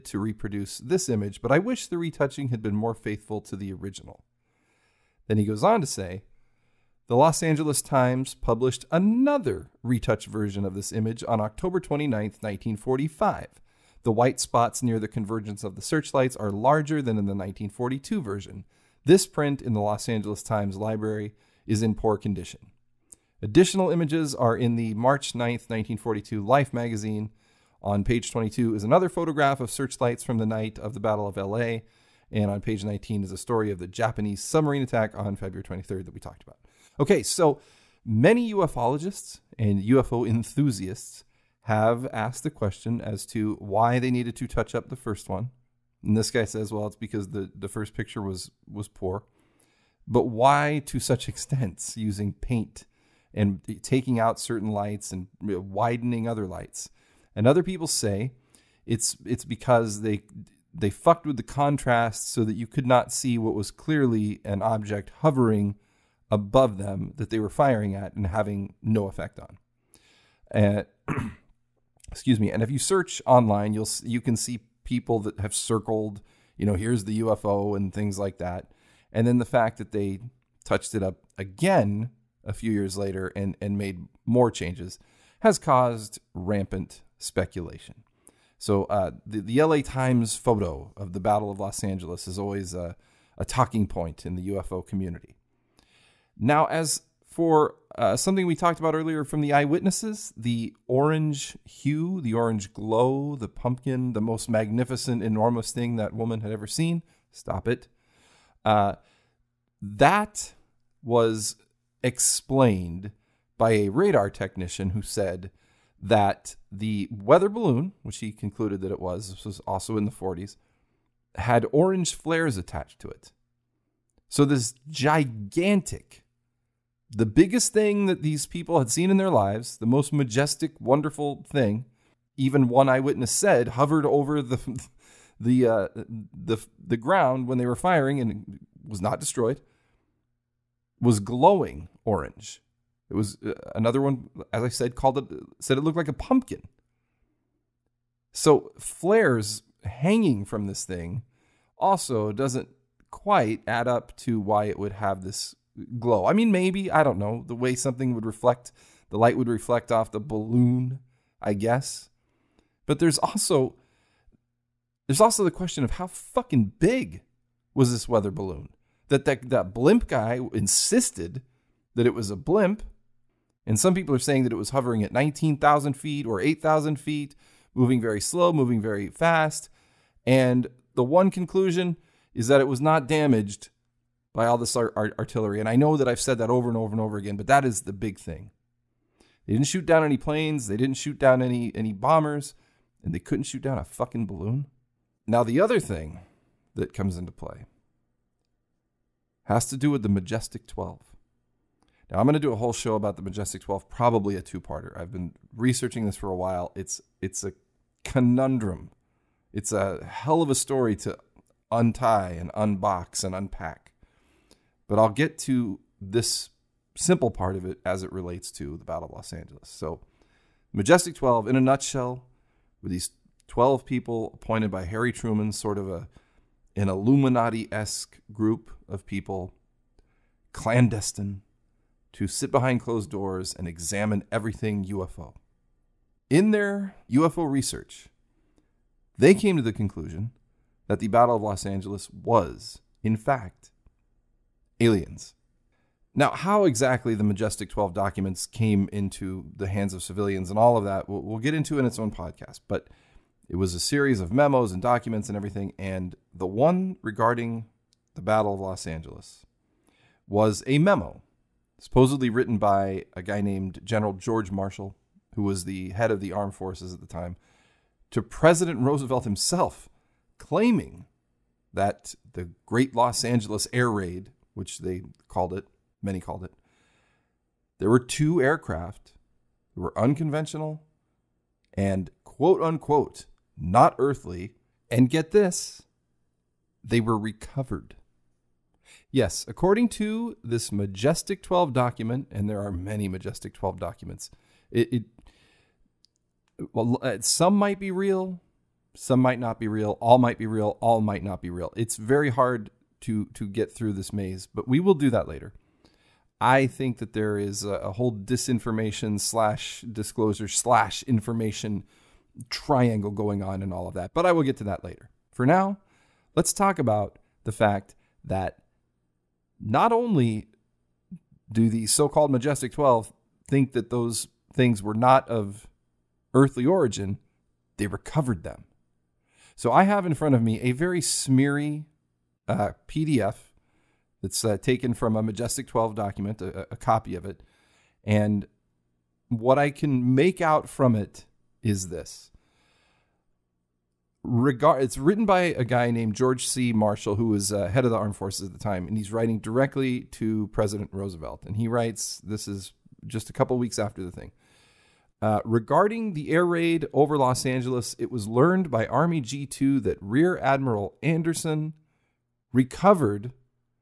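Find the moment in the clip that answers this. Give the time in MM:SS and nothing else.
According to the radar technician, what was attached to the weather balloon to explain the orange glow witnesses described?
02:01.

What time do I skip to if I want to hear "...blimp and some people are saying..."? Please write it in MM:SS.
02:52.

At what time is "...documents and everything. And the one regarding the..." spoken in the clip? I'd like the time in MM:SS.
04:14.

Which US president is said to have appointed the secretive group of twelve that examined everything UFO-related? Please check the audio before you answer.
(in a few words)
Harry Truman.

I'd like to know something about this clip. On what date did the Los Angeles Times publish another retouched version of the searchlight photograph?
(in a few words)
October 29, 1945.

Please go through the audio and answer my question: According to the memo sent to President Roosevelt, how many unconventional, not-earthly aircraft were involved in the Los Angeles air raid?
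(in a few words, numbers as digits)
2.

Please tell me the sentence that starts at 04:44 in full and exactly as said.
And get this, they were recovered.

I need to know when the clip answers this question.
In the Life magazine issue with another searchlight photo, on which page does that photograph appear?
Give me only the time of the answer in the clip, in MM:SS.
00:28.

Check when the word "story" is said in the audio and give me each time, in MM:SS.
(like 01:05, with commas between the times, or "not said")
00:33, 03:30.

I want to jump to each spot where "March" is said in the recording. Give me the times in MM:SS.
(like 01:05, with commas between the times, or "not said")
00:24.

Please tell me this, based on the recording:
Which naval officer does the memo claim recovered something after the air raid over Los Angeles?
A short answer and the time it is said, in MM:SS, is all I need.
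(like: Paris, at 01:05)
Rear Admiral Anderson, at 06:00.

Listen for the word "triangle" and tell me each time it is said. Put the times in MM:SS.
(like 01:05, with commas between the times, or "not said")
05:12.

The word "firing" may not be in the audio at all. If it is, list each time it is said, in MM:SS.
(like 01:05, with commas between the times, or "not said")
01:07, 02:17.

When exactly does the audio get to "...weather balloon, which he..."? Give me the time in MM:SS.
01:57.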